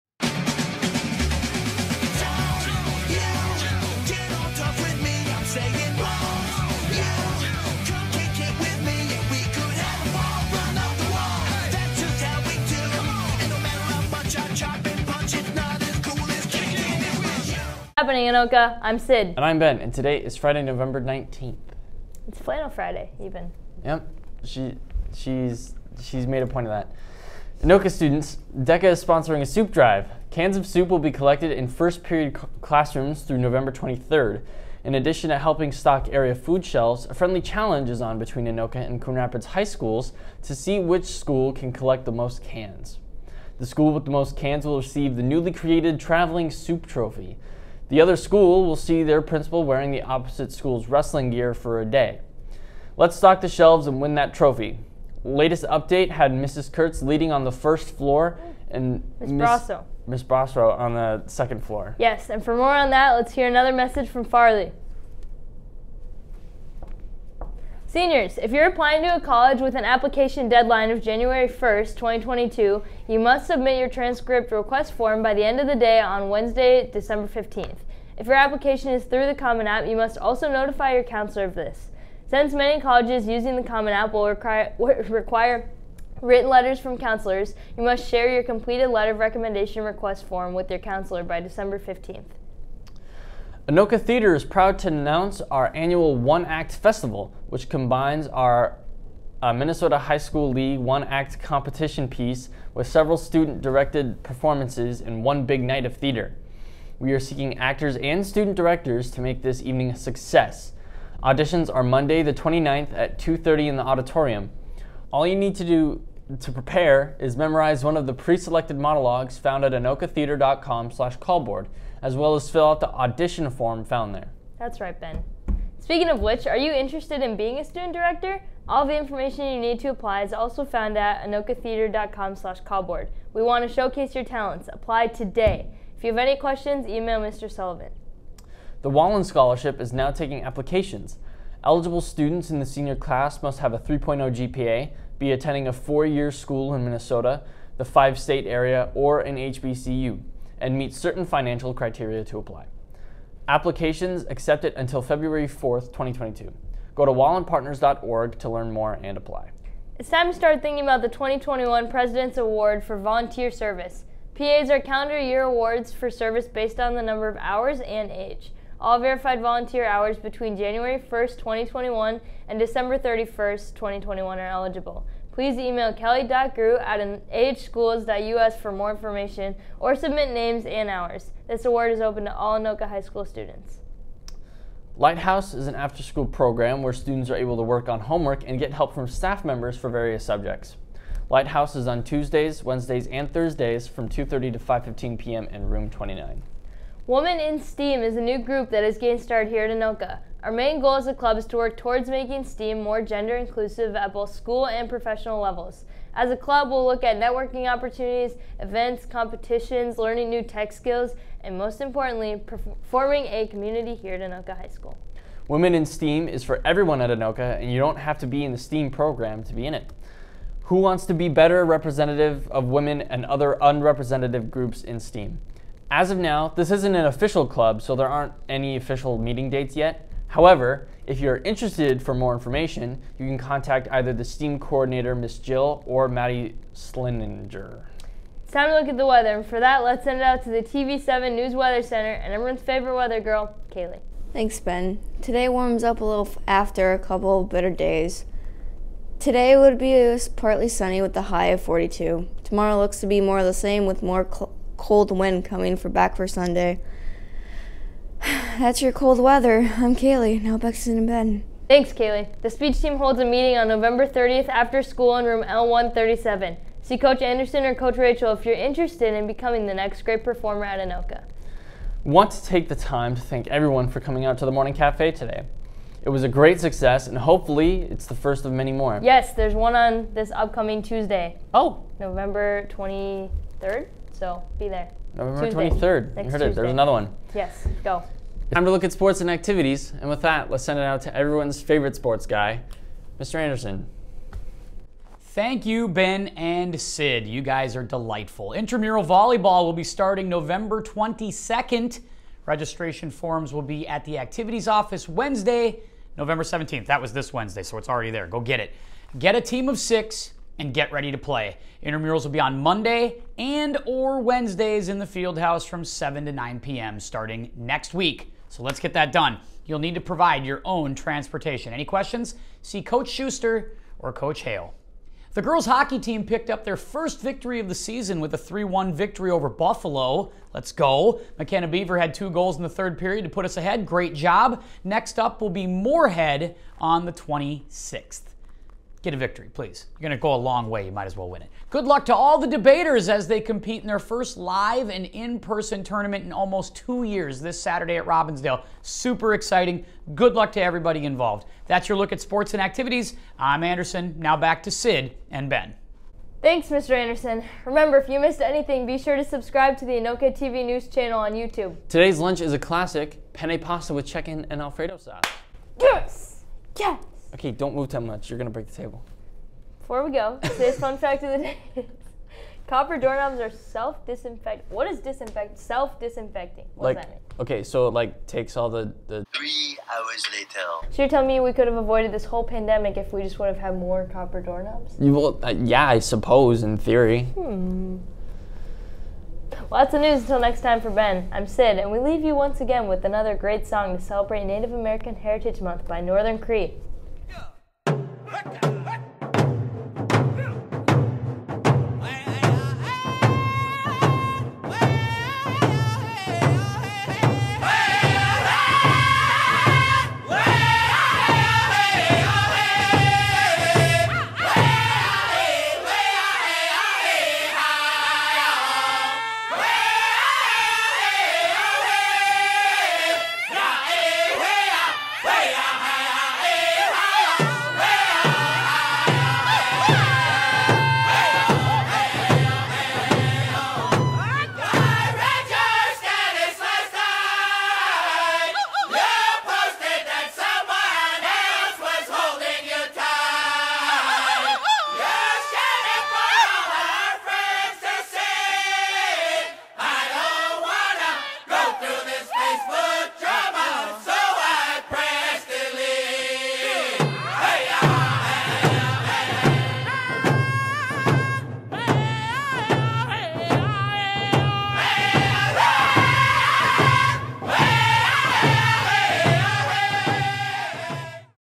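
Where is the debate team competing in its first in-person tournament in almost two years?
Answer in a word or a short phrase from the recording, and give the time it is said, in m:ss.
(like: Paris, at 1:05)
Robbinsdale, at 5:48.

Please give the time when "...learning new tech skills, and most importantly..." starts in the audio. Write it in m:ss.
3:29.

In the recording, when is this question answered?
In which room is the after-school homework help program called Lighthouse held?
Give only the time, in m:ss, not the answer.
3:15.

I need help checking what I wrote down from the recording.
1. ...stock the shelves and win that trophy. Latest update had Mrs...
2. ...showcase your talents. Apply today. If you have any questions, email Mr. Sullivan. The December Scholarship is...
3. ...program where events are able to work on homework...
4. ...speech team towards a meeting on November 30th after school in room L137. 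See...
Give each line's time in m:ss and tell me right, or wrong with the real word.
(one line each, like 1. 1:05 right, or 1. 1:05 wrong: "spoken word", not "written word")
1. 0:53 right
2. 2:13 wrong: "Wallin", not "December"
3. 3:06 wrong: "students", not "events"
4. 4:22 wrong: "holds", not "towards".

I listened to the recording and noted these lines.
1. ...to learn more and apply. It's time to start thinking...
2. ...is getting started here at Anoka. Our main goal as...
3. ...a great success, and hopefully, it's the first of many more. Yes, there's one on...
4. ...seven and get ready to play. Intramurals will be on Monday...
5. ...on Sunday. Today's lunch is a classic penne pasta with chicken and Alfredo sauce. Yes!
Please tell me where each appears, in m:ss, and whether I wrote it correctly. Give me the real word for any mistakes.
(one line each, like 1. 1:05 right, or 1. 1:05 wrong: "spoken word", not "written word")
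1. 2:38 right
2. 3:18 right
3. 4:36 right
4. 5:09 wrong: "six", not "seven"
5. 6:01 wrong: "YouTube", not "Sunday".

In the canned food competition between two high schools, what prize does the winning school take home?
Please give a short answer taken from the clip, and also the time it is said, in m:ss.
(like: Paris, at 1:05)
Traveling Soup Trophy, at 0:45.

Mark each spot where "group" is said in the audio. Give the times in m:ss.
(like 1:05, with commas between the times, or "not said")
3:18, 3:44.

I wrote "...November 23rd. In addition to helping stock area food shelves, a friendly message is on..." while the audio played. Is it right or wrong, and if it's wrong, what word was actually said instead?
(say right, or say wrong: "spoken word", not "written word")
wrong: "challenge", not "message".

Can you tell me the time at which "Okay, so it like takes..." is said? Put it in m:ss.
6:17.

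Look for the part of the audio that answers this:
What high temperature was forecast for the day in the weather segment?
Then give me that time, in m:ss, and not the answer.
4:11.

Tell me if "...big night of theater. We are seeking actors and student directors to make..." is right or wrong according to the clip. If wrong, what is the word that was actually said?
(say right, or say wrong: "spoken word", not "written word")
right.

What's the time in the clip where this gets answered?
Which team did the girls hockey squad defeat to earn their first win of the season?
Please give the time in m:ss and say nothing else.
5:29.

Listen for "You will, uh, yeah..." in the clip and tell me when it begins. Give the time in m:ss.
6:24.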